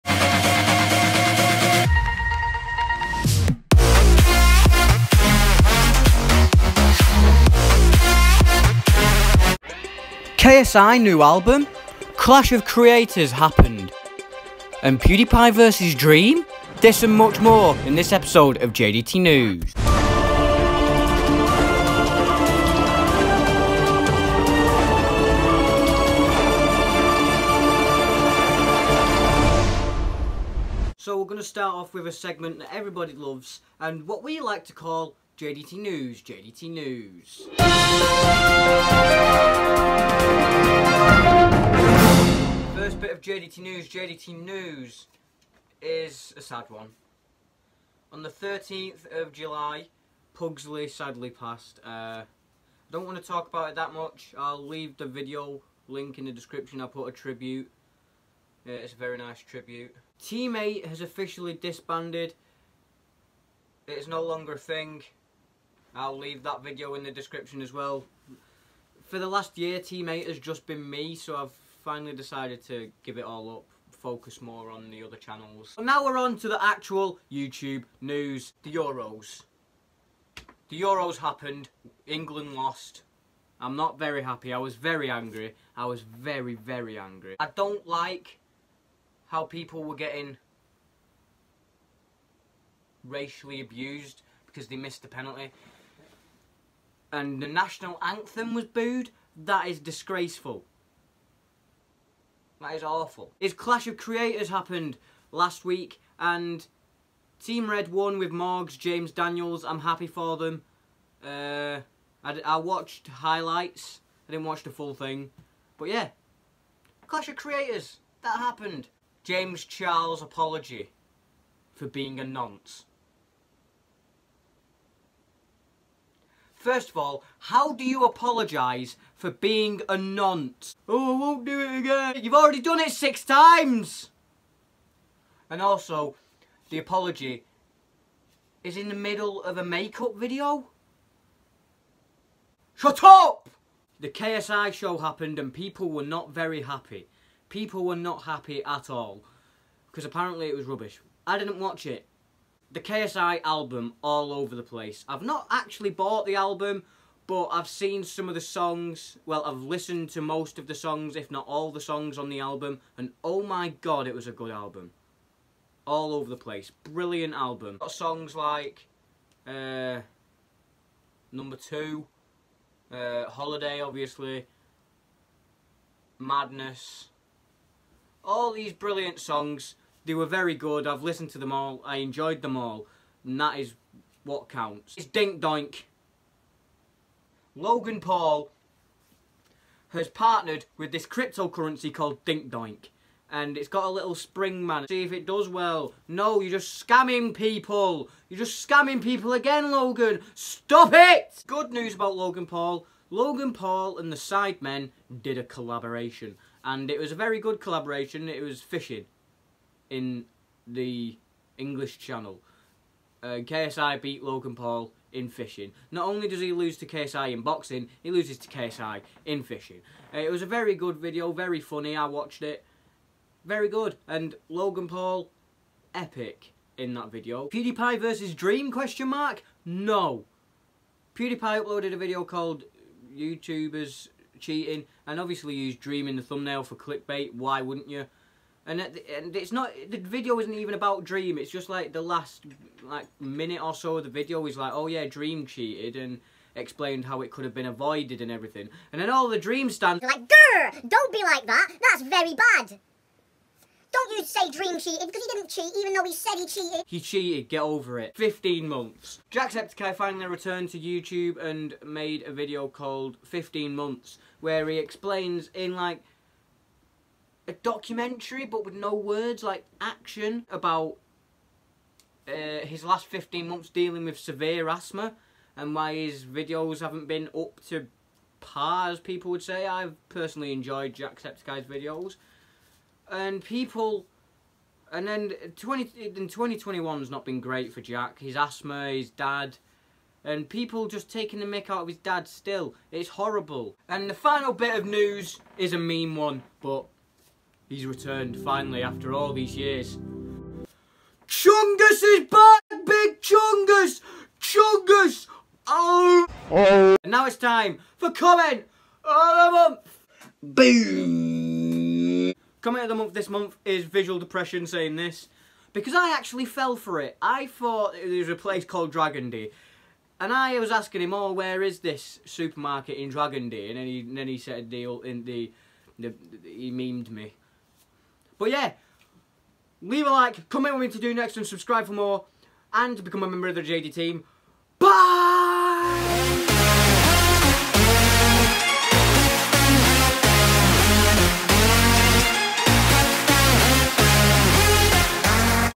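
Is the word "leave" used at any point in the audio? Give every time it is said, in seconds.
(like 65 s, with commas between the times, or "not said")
54 s, 66 s, 329 s.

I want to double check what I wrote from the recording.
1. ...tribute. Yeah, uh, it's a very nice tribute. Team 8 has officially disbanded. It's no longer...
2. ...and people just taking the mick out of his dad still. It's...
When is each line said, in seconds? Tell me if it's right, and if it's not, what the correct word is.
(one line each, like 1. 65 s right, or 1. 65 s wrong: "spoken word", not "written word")
1. 57 s right
2. 290 s right.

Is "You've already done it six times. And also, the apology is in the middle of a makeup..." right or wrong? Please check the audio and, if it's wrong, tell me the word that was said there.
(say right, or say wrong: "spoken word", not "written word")
right.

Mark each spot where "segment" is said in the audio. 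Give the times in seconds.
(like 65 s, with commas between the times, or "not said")
32 s.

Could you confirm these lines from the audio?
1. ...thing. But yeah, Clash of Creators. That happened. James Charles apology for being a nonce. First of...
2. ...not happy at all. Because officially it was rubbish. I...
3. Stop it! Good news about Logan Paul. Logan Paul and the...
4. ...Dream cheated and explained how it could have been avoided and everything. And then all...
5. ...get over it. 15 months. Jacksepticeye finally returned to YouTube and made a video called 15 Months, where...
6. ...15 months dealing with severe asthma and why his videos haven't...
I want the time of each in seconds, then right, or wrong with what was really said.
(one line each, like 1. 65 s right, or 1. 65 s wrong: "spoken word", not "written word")
1. 114 s right
2. 147 s wrong: "apparently", not "officially"
3. 200 s right
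4. 245 s right
5. 257 s right
6. 273 s right.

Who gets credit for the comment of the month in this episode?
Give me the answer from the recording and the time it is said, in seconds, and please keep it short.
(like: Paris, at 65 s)
Visual Depression, at 313 s.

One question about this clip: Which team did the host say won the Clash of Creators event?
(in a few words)
Team Red.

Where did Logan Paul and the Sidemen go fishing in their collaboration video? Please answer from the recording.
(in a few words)
English Channel.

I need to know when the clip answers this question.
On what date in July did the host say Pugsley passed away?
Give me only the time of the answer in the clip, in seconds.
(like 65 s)
48 s.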